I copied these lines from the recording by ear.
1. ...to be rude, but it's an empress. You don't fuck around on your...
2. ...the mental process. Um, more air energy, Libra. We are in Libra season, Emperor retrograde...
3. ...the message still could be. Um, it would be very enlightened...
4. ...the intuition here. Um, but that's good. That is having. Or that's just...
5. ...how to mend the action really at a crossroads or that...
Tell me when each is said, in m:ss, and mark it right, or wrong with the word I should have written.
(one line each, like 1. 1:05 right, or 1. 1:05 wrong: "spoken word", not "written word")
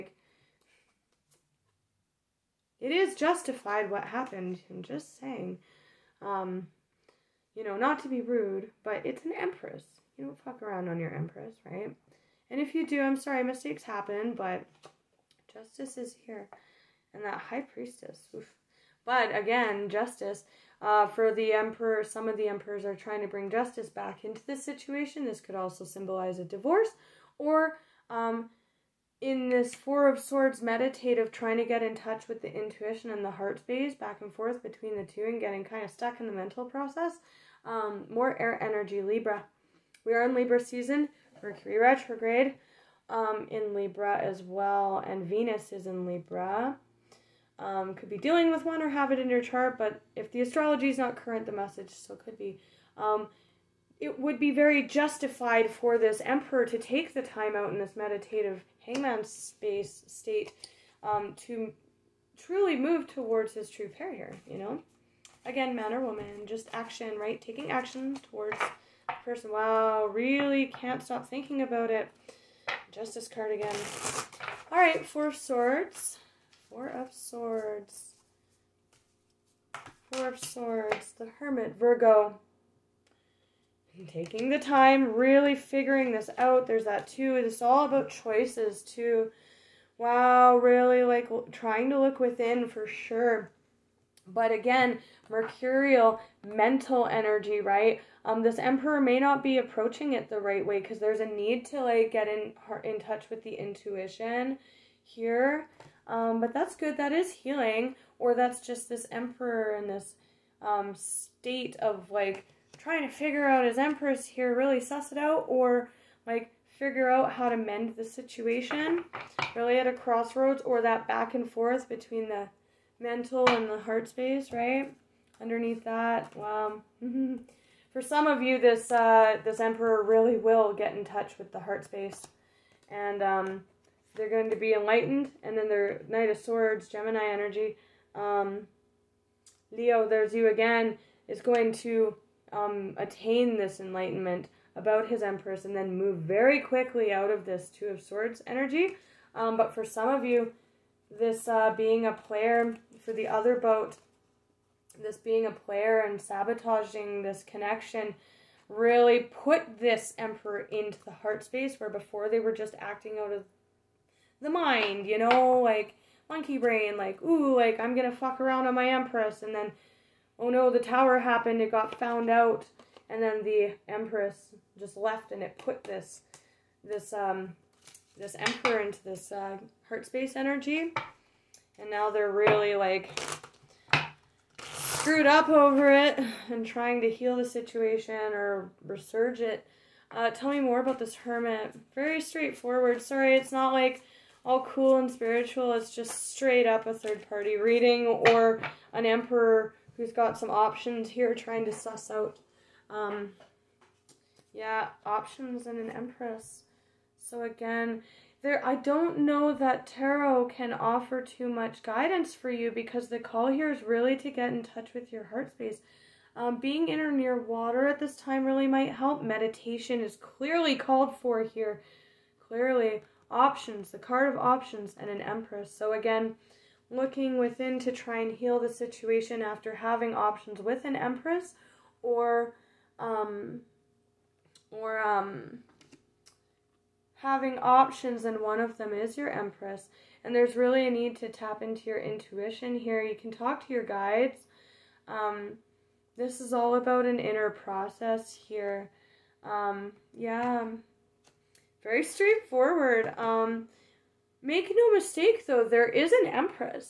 1. 0:08 right
2. 0:36 wrong: "Mercury", not "Emperor"
3. 0:51 wrong: "justified", not "enlightened"
4. 1:43 wrong: "healing", not "having"
5. 1:57 wrong: "situation", not "action".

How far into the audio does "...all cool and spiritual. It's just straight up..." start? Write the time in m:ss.
3:14.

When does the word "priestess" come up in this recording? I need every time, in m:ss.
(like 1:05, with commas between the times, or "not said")
0:17.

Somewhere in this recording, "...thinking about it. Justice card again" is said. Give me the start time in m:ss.
1:11.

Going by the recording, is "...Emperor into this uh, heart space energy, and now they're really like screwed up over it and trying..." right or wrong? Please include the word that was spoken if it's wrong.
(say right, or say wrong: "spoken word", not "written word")
right.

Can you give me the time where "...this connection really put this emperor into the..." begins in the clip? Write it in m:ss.
2:37.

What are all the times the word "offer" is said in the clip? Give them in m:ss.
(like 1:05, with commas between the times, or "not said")
3:30.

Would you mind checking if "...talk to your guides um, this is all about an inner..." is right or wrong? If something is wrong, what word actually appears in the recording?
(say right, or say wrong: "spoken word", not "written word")
right.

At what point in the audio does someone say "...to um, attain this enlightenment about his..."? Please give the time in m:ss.
2:21.